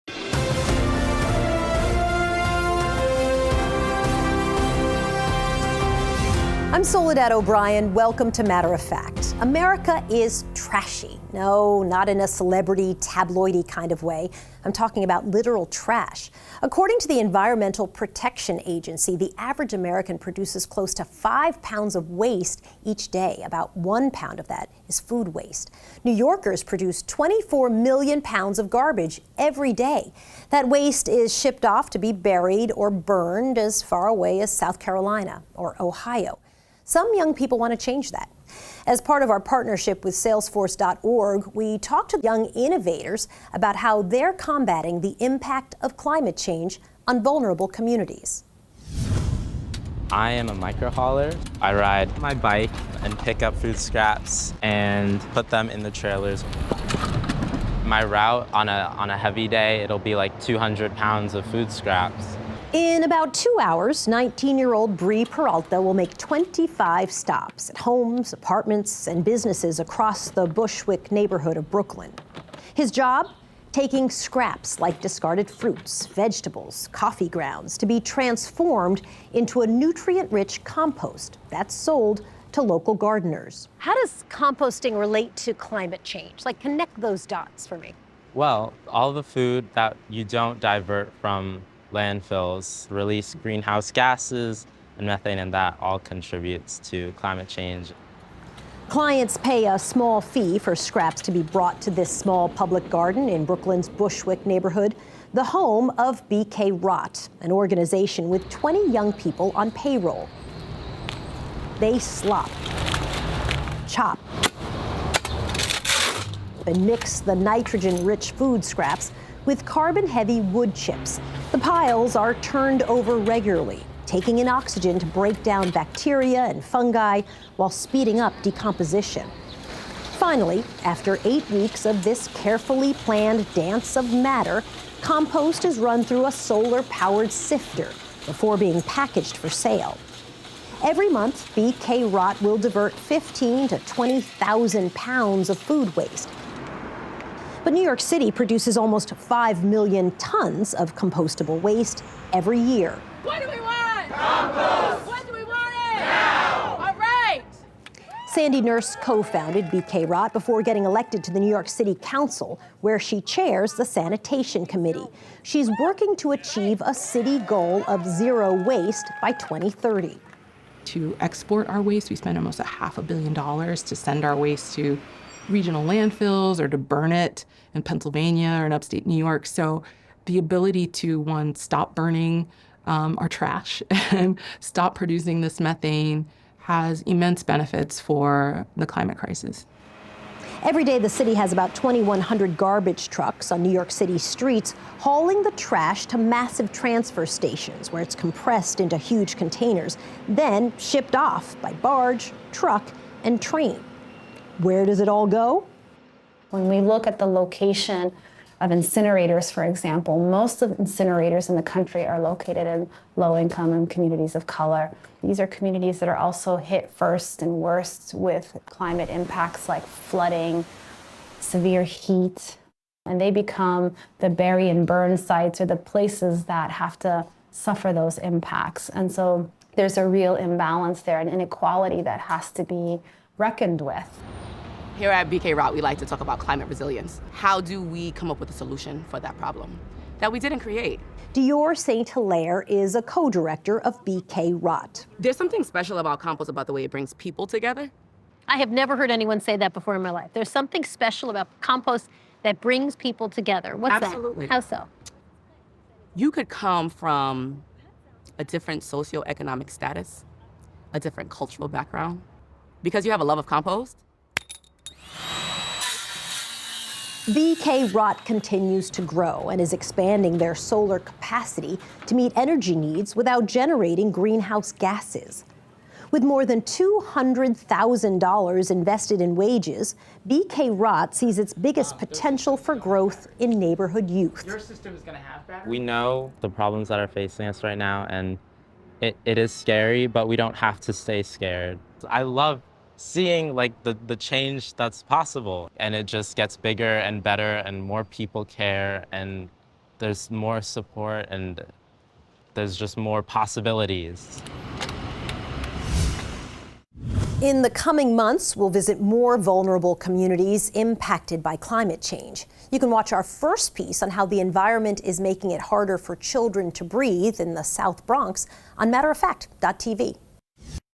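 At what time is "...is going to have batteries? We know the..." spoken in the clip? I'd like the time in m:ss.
4:44.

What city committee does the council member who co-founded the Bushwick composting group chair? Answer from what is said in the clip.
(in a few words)
Sanitation Committee.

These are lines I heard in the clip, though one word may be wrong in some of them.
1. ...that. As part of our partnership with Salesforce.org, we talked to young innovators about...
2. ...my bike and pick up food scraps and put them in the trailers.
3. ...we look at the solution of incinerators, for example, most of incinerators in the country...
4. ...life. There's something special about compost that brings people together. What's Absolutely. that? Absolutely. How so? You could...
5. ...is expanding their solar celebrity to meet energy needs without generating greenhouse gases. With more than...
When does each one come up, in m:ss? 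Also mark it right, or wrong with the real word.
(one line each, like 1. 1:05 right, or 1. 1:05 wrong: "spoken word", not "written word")
1. 0:38 right
2. 0:52 right
3. 3:26 wrong: "location", not "solution"
4. 4:10 right
5. 4:29 wrong: "capacity", not "celebrity".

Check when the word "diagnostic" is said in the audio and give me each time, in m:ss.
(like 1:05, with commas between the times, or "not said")
not said.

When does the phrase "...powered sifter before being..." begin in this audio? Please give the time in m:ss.
2:16.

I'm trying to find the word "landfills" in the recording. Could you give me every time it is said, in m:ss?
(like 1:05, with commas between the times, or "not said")
1:31, 2:55.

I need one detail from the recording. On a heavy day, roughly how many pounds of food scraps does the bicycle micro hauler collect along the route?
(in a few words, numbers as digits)
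200 pounds.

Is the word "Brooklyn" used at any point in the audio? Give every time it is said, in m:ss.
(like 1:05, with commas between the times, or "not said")
1:11, 1:43.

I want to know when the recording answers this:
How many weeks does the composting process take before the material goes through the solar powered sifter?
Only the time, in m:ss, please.
2:11.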